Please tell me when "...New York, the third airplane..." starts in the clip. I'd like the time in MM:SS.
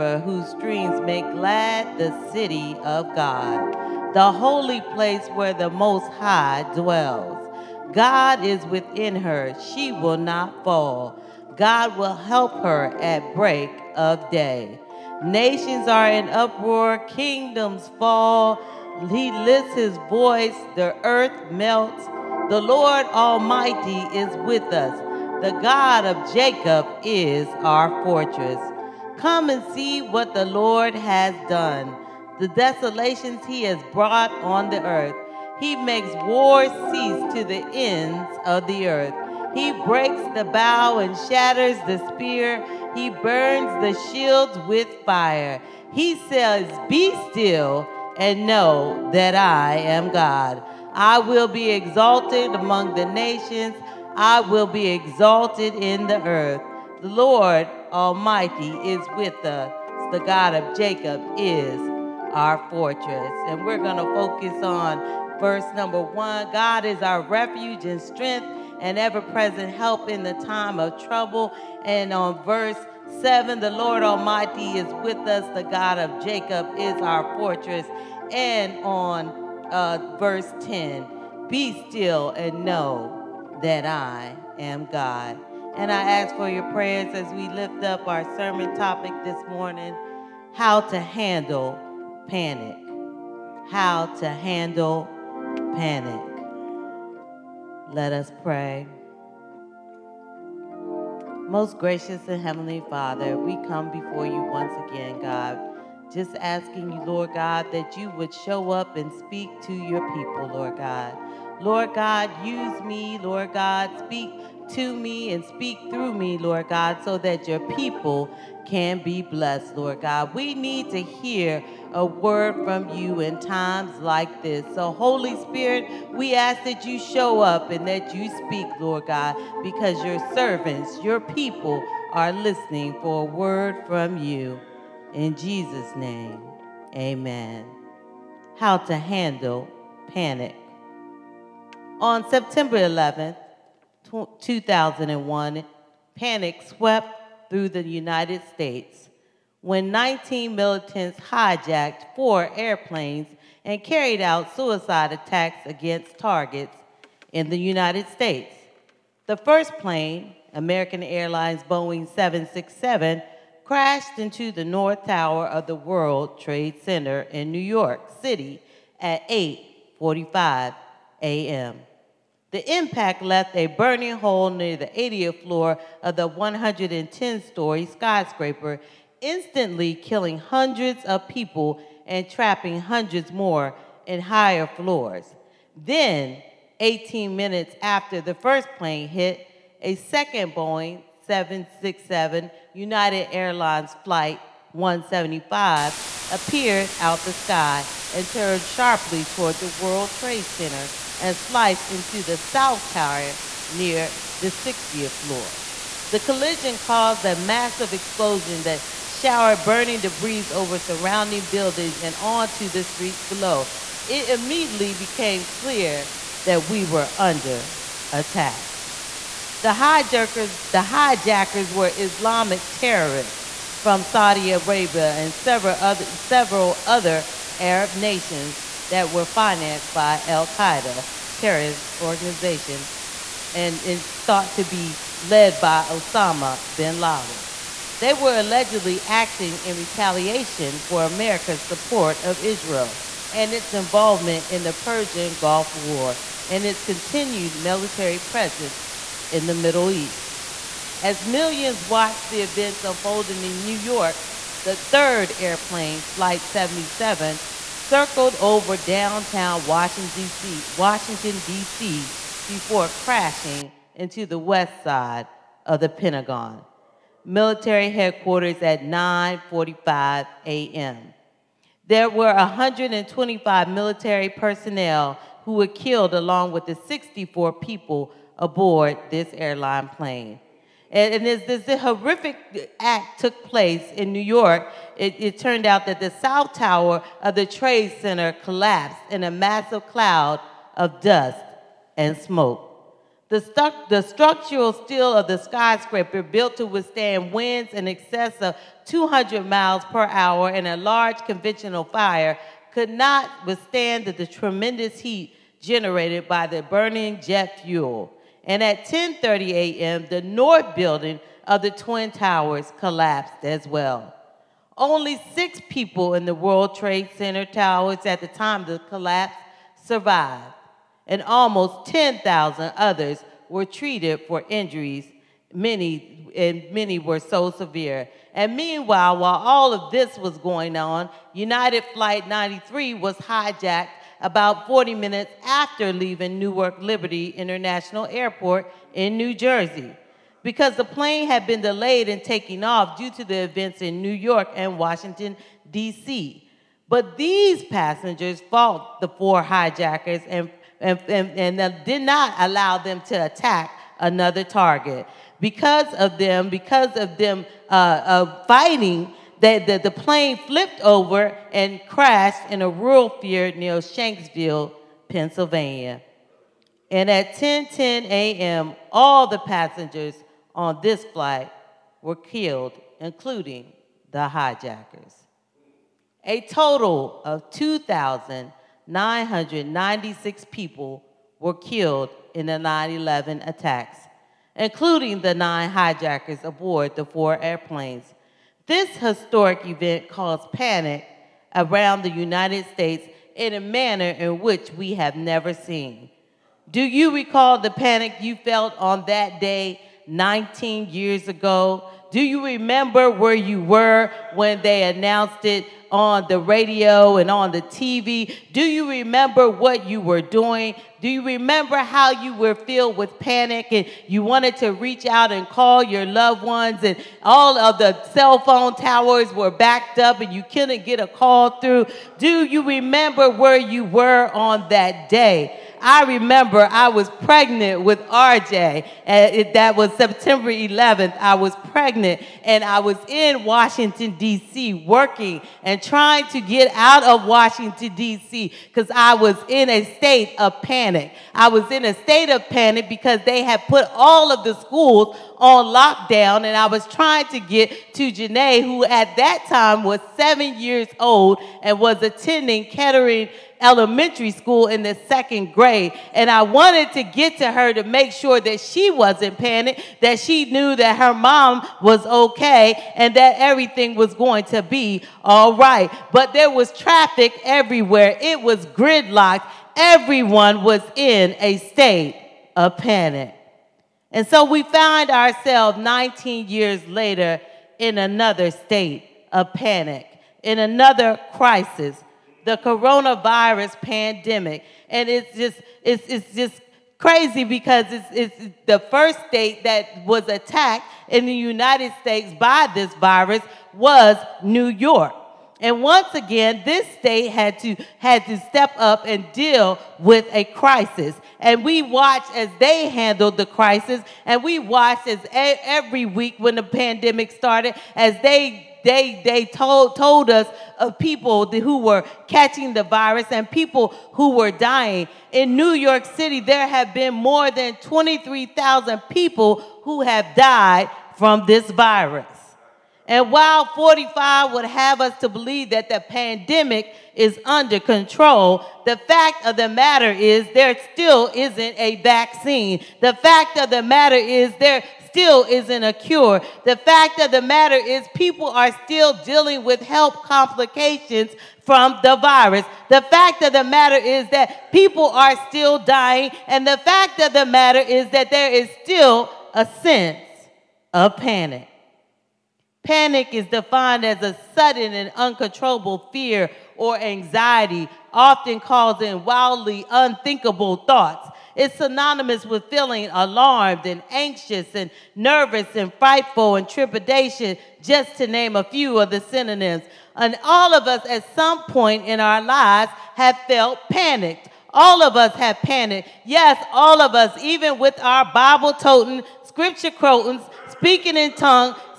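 04:13.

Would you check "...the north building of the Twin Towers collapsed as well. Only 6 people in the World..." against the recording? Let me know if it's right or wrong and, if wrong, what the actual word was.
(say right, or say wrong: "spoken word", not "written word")
right.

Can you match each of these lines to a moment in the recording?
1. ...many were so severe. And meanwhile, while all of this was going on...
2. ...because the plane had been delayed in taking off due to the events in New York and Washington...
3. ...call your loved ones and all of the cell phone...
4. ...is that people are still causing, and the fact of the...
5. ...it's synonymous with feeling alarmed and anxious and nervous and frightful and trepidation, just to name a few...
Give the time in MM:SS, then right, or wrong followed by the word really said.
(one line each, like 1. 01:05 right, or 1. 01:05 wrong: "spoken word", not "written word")
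1. 05:26 right
2. 05:40 right
3. 06:55 right
4. 09:04 wrong: "dying", not "causing"
5. 09:21 right.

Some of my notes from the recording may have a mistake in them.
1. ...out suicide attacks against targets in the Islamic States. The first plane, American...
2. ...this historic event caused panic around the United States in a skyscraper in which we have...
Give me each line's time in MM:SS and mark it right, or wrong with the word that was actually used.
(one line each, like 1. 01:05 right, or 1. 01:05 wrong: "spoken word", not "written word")
1. 02:34 wrong: "United", not "Islamic"
2. 06:28 wrong: "manner", not "skyscraper".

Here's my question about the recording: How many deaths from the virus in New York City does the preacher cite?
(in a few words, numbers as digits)
More than 23,000.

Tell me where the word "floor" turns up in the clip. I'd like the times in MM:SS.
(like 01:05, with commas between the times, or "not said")
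02:55, 03:04, 03:25.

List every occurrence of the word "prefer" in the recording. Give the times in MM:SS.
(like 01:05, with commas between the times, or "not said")
not said.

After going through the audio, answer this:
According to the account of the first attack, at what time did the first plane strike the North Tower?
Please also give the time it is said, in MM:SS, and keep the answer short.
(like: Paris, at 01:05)
8:45 a.m., at 02:49.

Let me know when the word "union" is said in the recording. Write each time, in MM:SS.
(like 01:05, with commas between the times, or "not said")
not said.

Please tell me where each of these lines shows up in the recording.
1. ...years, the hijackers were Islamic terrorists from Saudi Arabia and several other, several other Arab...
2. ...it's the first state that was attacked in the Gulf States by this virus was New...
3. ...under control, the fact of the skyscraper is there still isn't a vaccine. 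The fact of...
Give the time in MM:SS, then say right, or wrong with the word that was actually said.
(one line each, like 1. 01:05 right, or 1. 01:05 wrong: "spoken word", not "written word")
1. 03:39 wrong: "hijackers", not "years"
2. 08:08 wrong: "United", not "Gulf"
3. 08:47 wrong: "matter", not "skyscraper".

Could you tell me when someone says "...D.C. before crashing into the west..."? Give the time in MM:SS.
04:21.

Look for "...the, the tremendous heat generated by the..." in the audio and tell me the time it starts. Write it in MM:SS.
05:04.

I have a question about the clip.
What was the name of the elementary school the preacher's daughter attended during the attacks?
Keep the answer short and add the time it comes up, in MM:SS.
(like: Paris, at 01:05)
Kettering, at 07:32.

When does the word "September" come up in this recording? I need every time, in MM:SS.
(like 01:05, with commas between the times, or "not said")
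02:22, 07:09.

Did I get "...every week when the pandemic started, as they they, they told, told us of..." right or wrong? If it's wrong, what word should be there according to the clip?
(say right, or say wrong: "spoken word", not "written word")
right.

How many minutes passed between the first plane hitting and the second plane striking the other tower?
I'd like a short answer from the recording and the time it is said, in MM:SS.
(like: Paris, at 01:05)
18, at 03:06.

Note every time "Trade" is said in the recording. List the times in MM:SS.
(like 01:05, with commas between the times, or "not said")
02:46, 03:20, 04:47, 05:16.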